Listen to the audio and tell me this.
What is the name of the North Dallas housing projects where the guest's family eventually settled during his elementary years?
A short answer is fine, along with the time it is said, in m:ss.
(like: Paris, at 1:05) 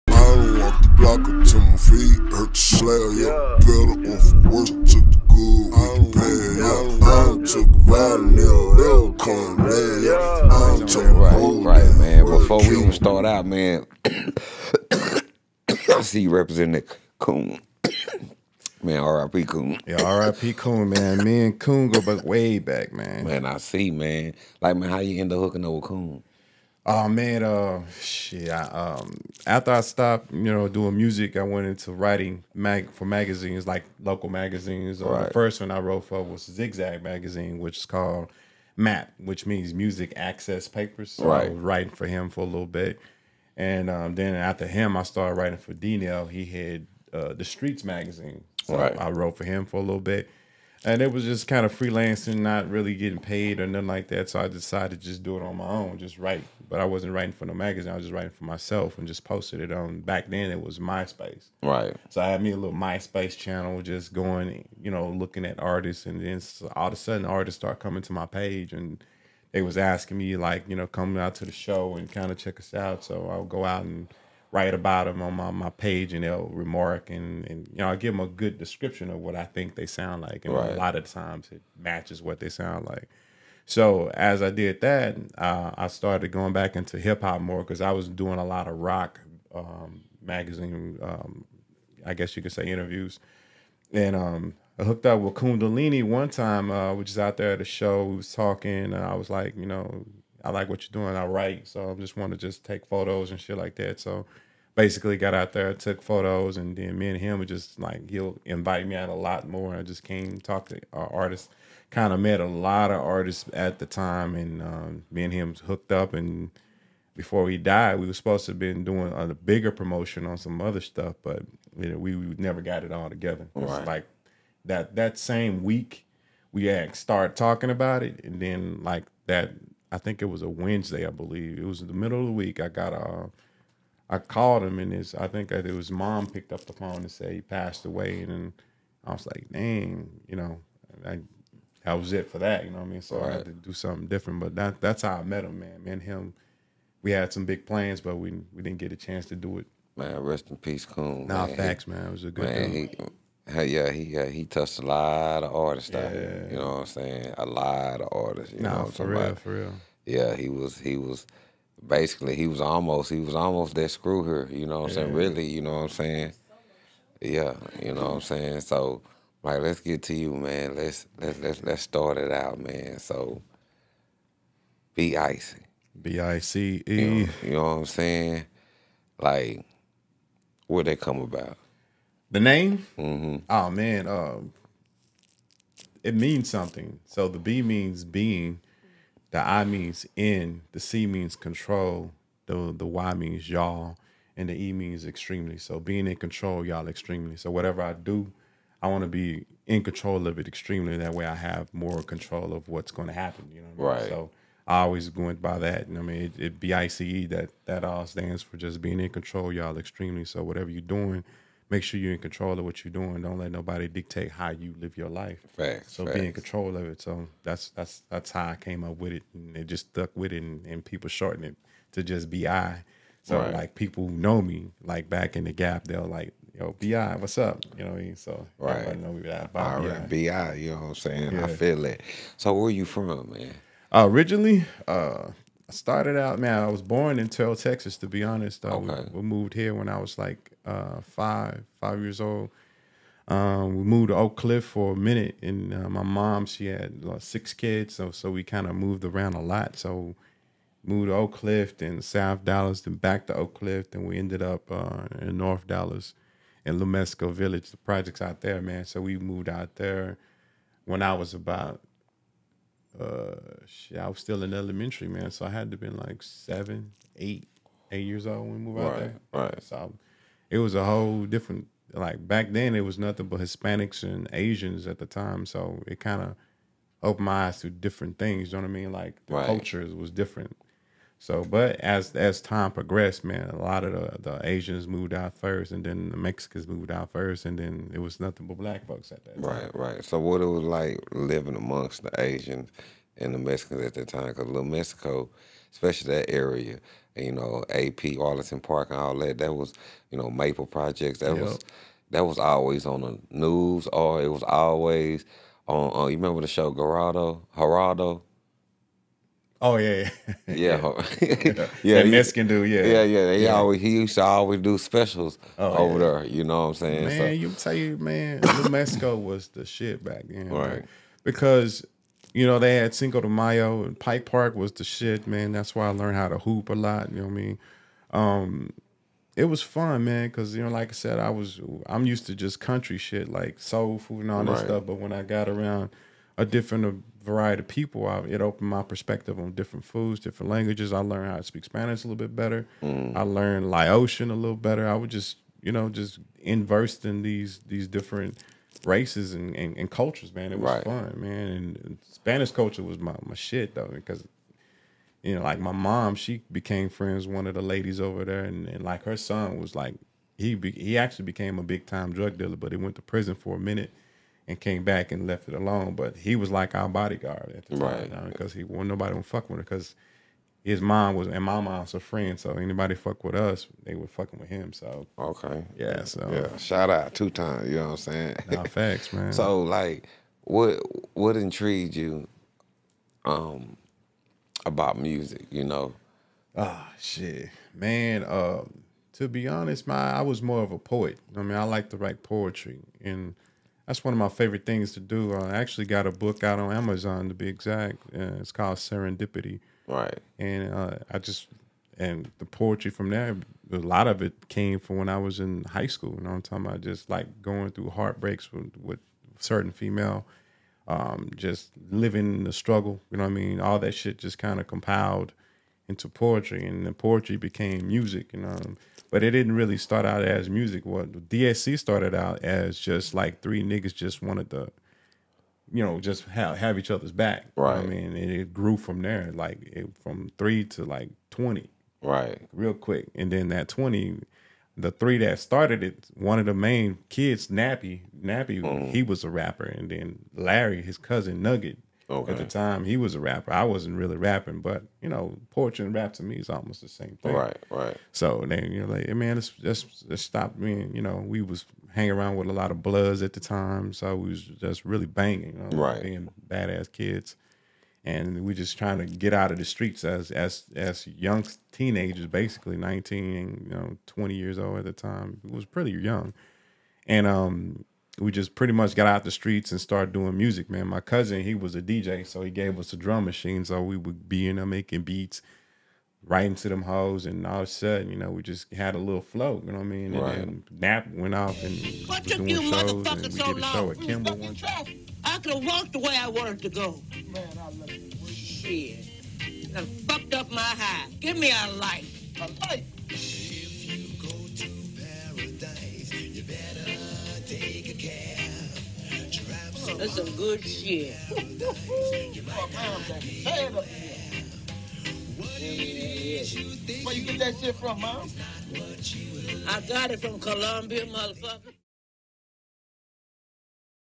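Lumesco Village, at 4:16.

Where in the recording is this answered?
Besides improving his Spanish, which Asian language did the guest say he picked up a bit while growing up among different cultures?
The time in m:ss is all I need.
5:43.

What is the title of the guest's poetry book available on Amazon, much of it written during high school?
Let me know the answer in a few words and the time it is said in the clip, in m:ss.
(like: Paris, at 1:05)
Serendipity, at 6:38.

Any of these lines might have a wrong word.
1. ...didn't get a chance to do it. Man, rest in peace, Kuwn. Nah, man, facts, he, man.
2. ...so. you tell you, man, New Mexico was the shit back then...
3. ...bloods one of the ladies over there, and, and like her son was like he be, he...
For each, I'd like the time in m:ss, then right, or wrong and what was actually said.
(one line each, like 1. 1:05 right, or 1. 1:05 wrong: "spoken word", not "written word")
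1. 2:28 right
2. 5:17 right
3. 5:56 wrong: "friends", not "bloods".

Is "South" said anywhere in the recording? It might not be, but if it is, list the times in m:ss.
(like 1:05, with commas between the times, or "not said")
4:12.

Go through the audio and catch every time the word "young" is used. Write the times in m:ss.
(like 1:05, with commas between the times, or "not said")
7:41, 7:45.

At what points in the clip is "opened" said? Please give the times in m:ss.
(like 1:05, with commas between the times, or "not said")
4:37, 5:38.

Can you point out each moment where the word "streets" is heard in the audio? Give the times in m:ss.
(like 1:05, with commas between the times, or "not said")
0:47, 7:39, 7:49.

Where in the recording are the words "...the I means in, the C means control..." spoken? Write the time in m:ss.
3:09.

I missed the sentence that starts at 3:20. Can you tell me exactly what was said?
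That way, I have more control of what's going to happen.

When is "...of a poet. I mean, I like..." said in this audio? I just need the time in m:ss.
6:30.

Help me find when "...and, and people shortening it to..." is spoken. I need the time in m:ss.
3:40.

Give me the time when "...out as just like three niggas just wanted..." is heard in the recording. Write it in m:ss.
7:02.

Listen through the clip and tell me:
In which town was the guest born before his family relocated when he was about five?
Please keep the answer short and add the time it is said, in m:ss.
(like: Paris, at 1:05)
Terrell, Texas, at 3:57.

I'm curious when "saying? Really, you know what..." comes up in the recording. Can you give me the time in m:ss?
2:45.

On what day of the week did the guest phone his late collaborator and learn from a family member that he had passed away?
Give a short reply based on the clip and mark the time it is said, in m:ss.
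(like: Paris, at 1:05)
Wednesday, at 2:10.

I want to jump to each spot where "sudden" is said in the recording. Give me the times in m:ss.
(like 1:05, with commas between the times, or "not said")
1:06, 7:57.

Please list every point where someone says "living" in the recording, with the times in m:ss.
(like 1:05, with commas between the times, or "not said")
4:51, 6:51.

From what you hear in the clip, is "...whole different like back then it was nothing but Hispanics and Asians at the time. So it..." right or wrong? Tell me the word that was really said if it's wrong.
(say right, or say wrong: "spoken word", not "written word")
right.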